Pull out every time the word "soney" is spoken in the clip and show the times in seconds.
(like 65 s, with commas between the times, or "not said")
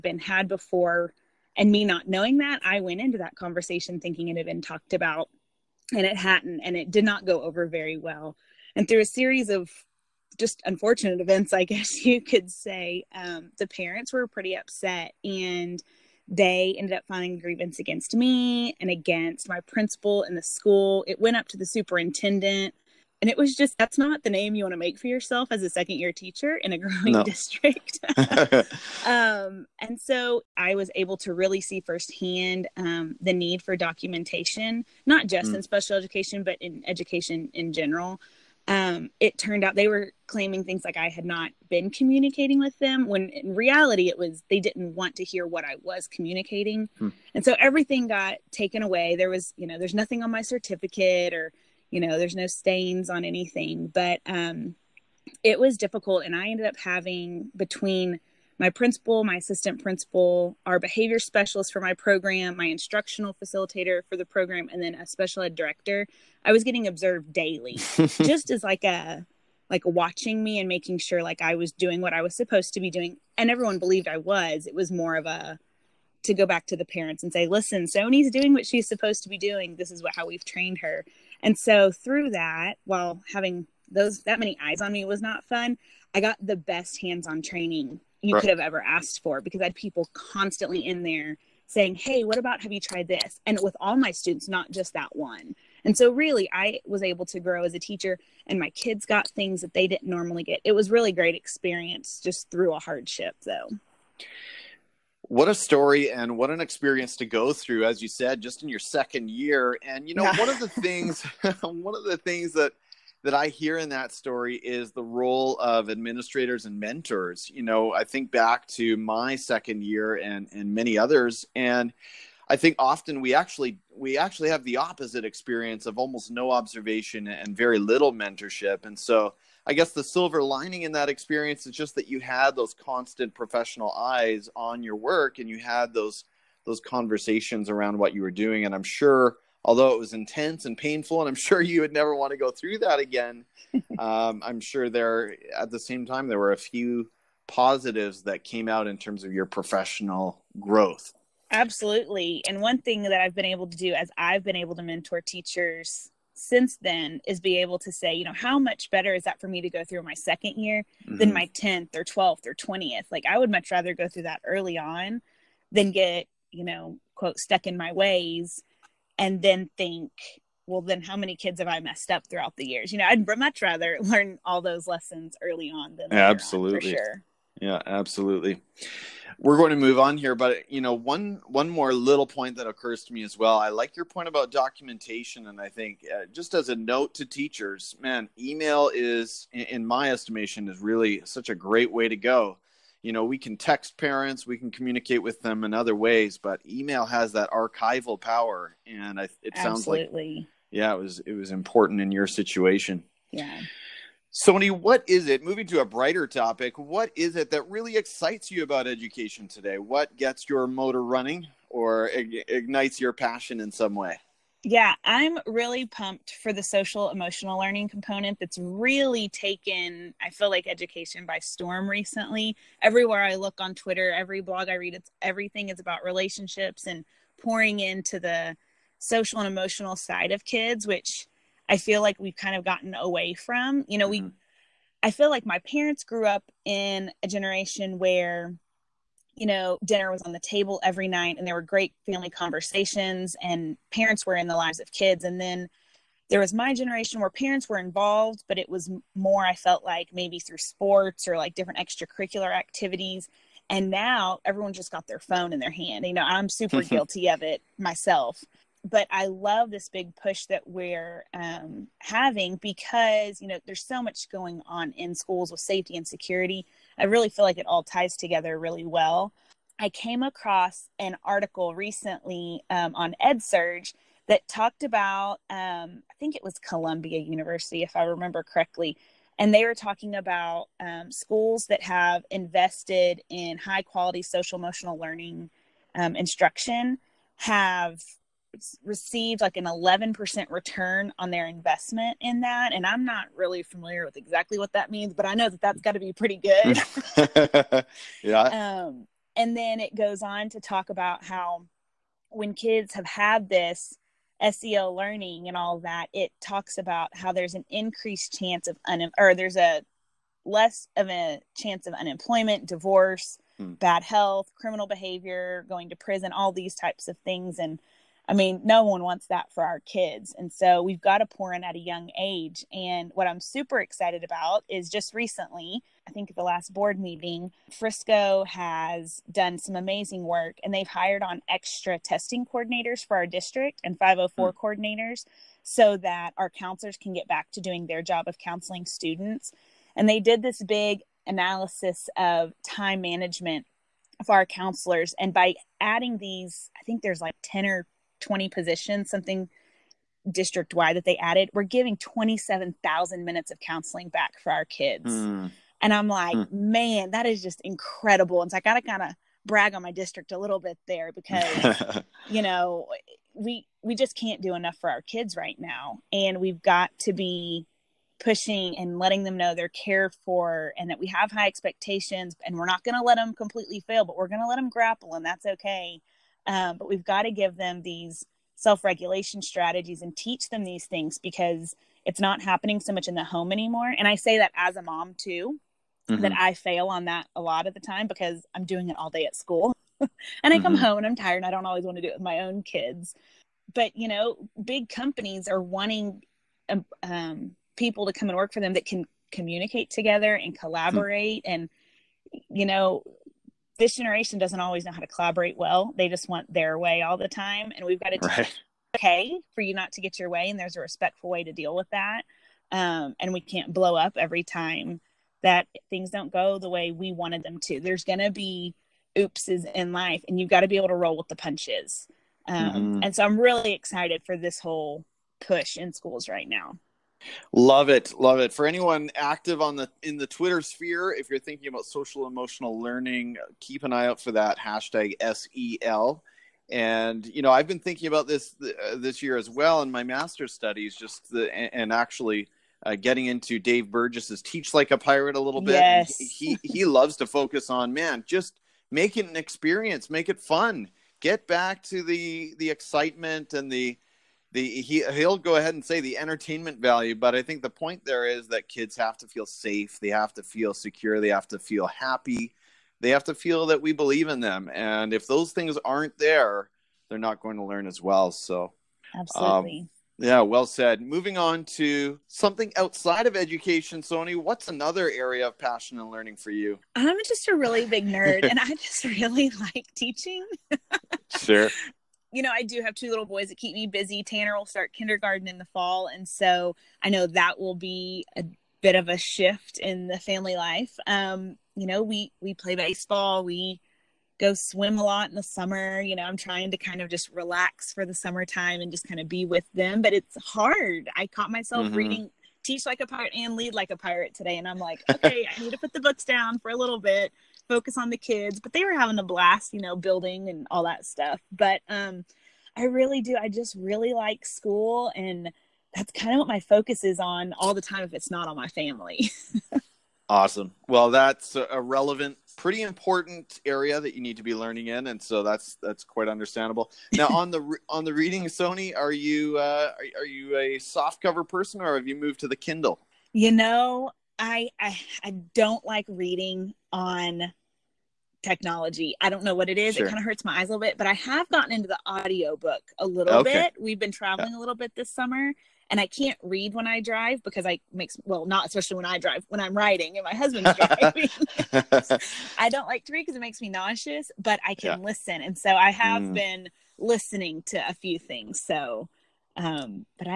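77 s, 204 s, 474 s, 528 s.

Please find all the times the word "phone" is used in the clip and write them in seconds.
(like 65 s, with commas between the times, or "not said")
255 s.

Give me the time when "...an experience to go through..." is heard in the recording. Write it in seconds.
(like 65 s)
106 s.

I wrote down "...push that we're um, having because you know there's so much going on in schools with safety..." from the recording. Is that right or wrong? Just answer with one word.
right.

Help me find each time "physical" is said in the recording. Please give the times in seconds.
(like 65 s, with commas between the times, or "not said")
not said.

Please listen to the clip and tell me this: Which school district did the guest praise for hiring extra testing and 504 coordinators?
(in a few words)
Frisco.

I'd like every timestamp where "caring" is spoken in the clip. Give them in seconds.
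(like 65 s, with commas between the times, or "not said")
not said.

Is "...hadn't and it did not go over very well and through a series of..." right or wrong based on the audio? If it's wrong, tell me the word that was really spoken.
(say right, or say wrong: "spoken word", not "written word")
right.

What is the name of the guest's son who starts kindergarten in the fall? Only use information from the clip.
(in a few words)
Tanner.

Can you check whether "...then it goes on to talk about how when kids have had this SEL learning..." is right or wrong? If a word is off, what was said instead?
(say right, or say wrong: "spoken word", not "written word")
right.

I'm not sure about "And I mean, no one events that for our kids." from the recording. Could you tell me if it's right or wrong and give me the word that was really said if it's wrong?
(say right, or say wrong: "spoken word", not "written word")
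wrong: "wants", not "events".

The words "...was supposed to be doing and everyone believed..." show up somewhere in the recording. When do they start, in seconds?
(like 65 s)
72 s.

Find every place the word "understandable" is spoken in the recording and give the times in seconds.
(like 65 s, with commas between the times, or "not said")
526 s.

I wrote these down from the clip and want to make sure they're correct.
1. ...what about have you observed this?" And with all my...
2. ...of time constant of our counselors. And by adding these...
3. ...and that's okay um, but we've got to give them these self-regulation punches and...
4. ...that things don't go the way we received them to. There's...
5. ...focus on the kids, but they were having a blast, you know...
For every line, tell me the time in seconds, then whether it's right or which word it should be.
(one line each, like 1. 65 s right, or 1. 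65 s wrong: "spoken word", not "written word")
1. 92 s wrong: "tried", not "observed"
2. 342 s wrong: "management", not "constant"
3. 375 s wrong: "strategies", not "punches"
4. 415 s wrong: "wanted", not "received"
5. 507 s right.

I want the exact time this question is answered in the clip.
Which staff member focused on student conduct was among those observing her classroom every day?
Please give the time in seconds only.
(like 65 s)
60 s.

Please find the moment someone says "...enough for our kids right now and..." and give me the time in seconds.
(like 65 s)
364 s.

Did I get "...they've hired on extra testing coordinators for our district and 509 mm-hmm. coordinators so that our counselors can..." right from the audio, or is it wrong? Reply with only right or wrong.
wrong.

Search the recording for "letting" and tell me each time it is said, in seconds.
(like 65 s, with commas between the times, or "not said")
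368 s.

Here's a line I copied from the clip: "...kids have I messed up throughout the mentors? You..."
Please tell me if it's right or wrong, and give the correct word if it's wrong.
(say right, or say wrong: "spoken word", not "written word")
wrong: "years", not "mentors".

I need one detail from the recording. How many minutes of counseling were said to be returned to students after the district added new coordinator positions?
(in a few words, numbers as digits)
27,000.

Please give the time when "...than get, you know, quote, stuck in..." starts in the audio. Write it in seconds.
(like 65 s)
165 s.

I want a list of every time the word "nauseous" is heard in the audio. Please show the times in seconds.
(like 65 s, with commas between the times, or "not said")
553 s.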